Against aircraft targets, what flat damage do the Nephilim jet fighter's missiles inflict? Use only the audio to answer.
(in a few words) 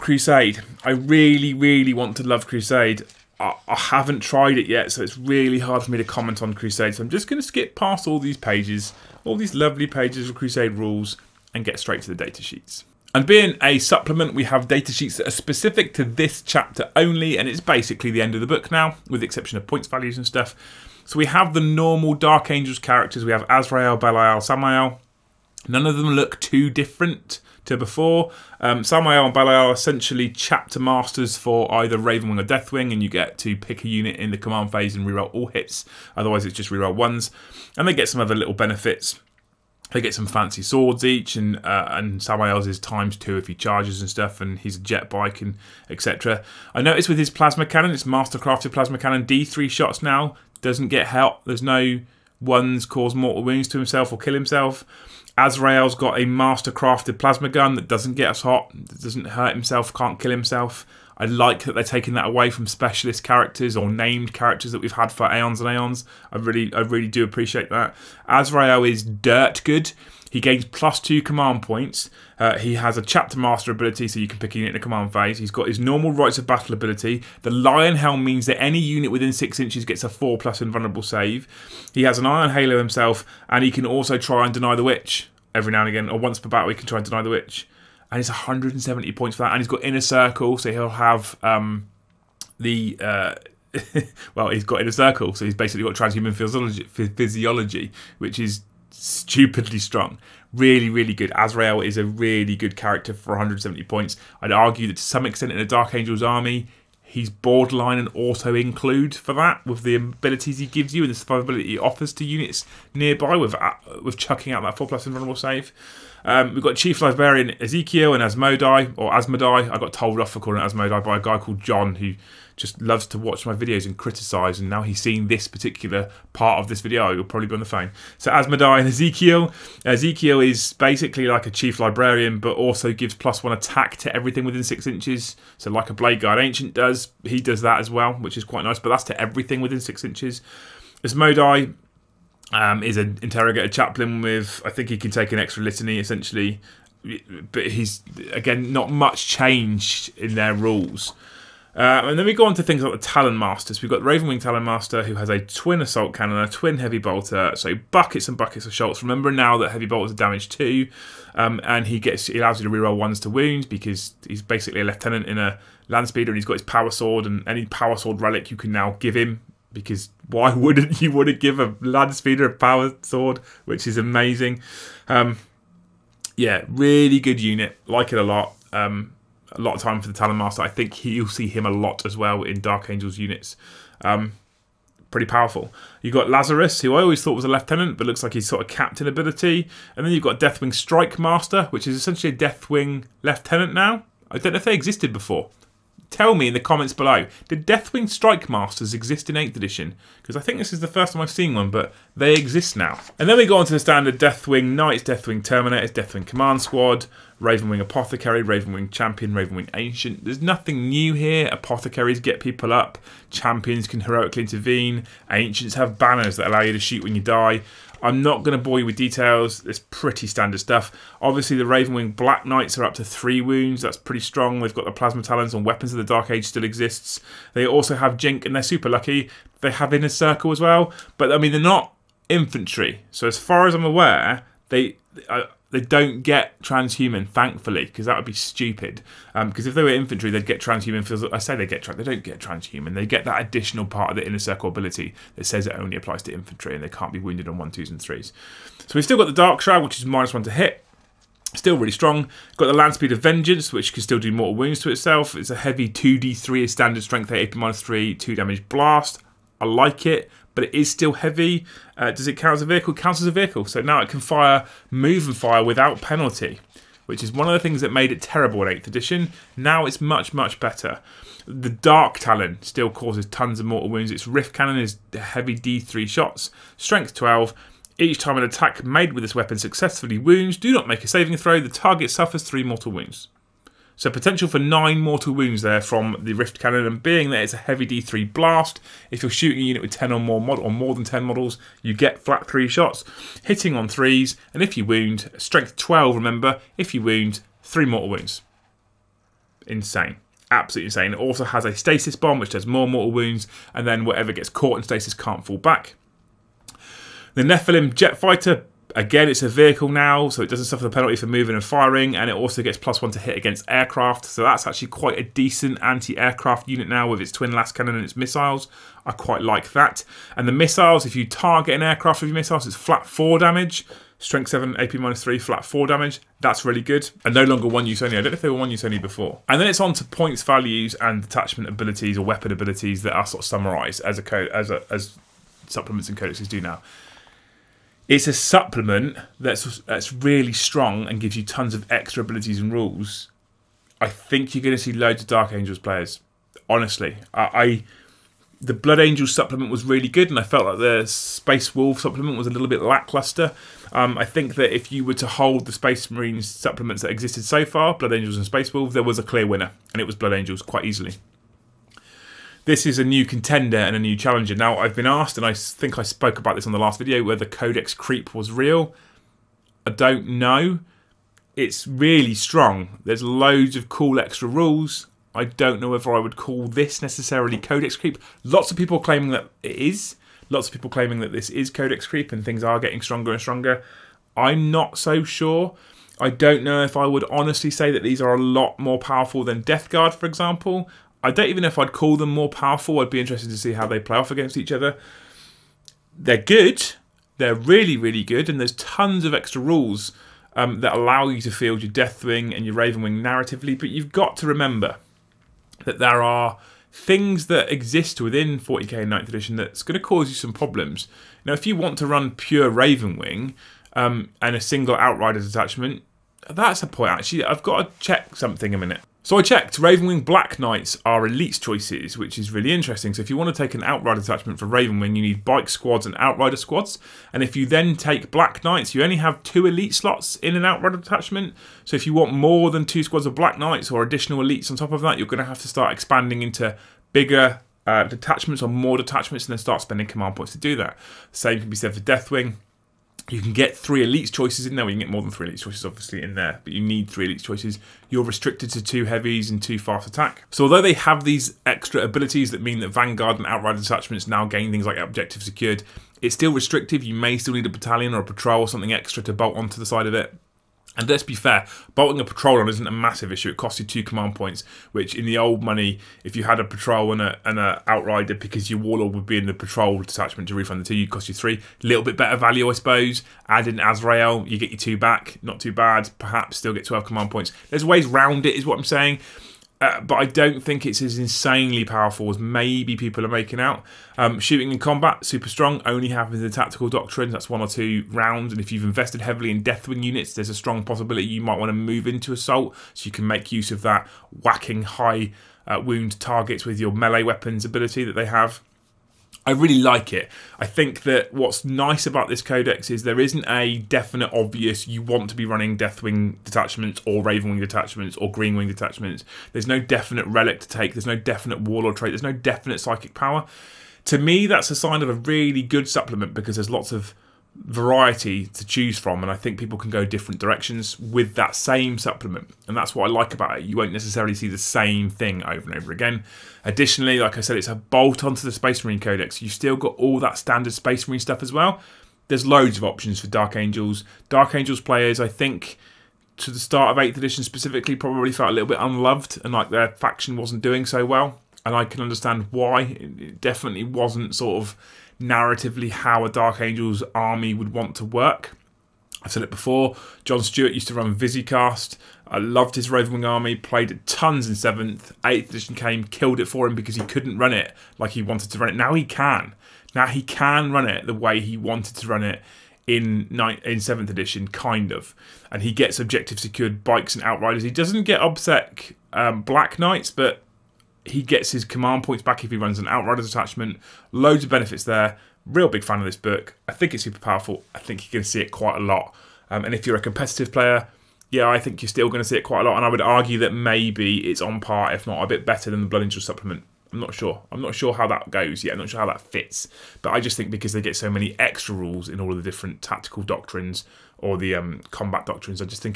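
4.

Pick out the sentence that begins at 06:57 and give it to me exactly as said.
I've got to check something a minute.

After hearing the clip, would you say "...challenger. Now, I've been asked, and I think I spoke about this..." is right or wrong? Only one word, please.
right.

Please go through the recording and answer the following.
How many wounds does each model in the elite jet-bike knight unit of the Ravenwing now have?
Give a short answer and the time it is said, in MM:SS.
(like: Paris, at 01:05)
3, at 03:43.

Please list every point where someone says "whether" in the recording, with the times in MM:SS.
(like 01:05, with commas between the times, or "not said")
06:07, 06:15.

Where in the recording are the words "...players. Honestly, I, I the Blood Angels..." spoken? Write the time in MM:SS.
05:45.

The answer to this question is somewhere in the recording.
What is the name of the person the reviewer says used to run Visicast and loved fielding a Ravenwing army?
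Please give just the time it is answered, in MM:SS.
09:10.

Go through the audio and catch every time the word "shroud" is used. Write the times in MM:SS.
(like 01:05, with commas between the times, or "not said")
04:09.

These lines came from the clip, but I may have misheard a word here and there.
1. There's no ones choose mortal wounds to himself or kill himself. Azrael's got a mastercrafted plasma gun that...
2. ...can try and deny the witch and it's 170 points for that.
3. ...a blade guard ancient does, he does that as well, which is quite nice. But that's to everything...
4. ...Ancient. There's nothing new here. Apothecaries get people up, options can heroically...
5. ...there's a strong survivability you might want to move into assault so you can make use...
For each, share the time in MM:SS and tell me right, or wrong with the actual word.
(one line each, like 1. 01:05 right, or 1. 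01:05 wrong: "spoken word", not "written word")
1. 00:51 wrong: "cause", not "choose"
2. 01:26 right
3. 02:15 right
4. 03:29 wrong: "champions", not "options"
5. 08:10 wrong: "possibility", not "survivability".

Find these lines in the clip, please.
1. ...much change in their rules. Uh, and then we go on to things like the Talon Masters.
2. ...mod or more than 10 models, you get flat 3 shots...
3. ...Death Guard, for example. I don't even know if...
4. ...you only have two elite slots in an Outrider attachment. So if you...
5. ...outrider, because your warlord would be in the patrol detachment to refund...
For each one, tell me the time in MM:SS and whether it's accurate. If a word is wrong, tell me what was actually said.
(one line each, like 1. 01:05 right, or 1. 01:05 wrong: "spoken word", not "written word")
1. 02:28 right
2. 04:50 right
3. 06:29 right
4. 07:08 right
5. 07:47 right.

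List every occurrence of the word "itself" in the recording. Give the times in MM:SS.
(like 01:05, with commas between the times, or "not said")
04:14.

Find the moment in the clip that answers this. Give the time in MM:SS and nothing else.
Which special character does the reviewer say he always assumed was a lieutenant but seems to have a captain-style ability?
03:06.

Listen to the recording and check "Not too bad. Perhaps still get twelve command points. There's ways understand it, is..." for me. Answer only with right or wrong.
wrong.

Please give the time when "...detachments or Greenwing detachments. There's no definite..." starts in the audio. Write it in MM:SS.
08:27.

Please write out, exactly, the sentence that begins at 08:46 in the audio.
Additionally, like I said, it's a bolt onto the Space Marine Codex.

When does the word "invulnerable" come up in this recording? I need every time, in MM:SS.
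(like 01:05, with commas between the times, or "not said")
01:20, 01:55.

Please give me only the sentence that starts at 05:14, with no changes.
So that's actually quite a decent anti aircraft unit now with its twin lascannon and its missiles.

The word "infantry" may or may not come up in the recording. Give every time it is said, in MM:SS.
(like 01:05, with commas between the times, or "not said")
03:52, 03:59, 04:06.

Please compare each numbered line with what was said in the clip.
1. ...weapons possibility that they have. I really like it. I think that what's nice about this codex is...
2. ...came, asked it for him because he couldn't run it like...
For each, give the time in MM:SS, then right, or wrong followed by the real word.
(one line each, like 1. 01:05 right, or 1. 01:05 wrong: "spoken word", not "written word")
1. 08:17 wrong: "ability", not "possibility"
2. 09:15 wrong: "killed", not "asked".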